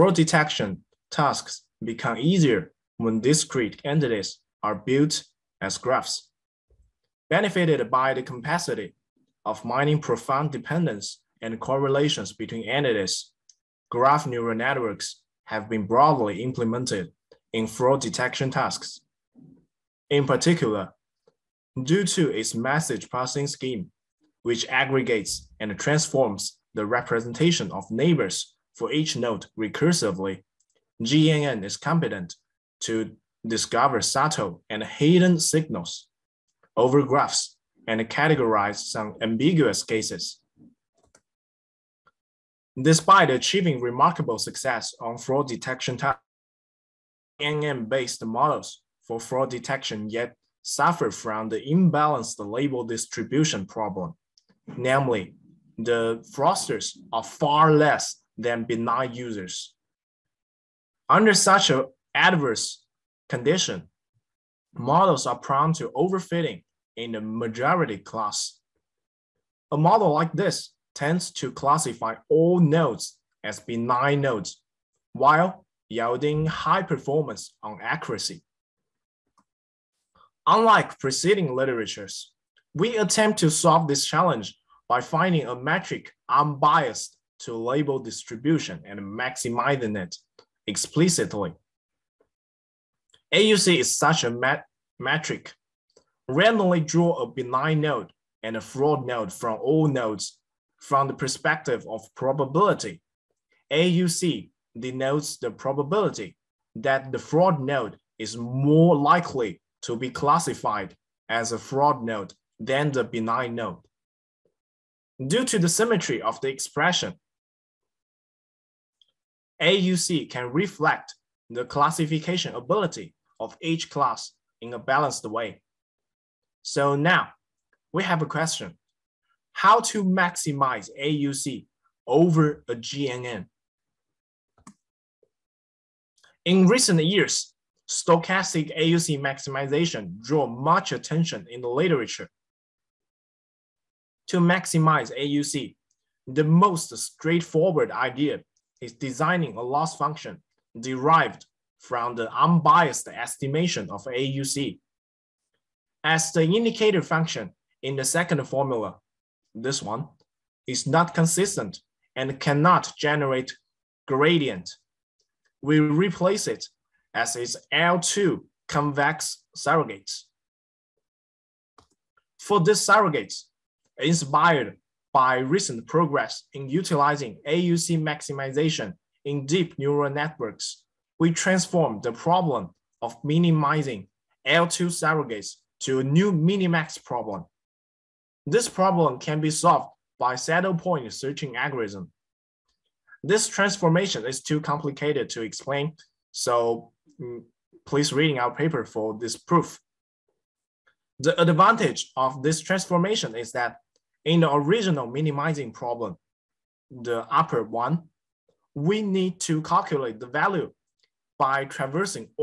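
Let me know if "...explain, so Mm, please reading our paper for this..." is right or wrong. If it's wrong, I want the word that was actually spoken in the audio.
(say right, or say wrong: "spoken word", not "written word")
right.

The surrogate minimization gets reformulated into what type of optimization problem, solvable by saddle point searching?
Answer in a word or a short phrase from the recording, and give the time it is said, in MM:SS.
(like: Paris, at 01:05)
minimax problem, at 03:06.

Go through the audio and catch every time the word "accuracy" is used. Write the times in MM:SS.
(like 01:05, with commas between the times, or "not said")
01:17.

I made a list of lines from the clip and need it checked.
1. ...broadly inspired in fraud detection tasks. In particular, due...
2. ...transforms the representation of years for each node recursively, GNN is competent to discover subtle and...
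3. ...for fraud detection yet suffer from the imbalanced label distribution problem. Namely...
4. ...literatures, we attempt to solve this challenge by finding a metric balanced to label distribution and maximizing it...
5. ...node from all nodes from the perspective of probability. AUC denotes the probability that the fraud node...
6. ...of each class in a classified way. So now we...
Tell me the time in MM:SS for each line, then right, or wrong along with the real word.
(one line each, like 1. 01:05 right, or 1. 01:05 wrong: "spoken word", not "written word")
1. 00:15 wrong: "implemented", not "inspired"
2. 00:25 wrong: "neighbors", not "years"
3. 00:49 right
4. 01:21 wrong: "unbiased", not "balanced"
5. 01:39 right
6. 02:03 wrong: "balanced", not "classified".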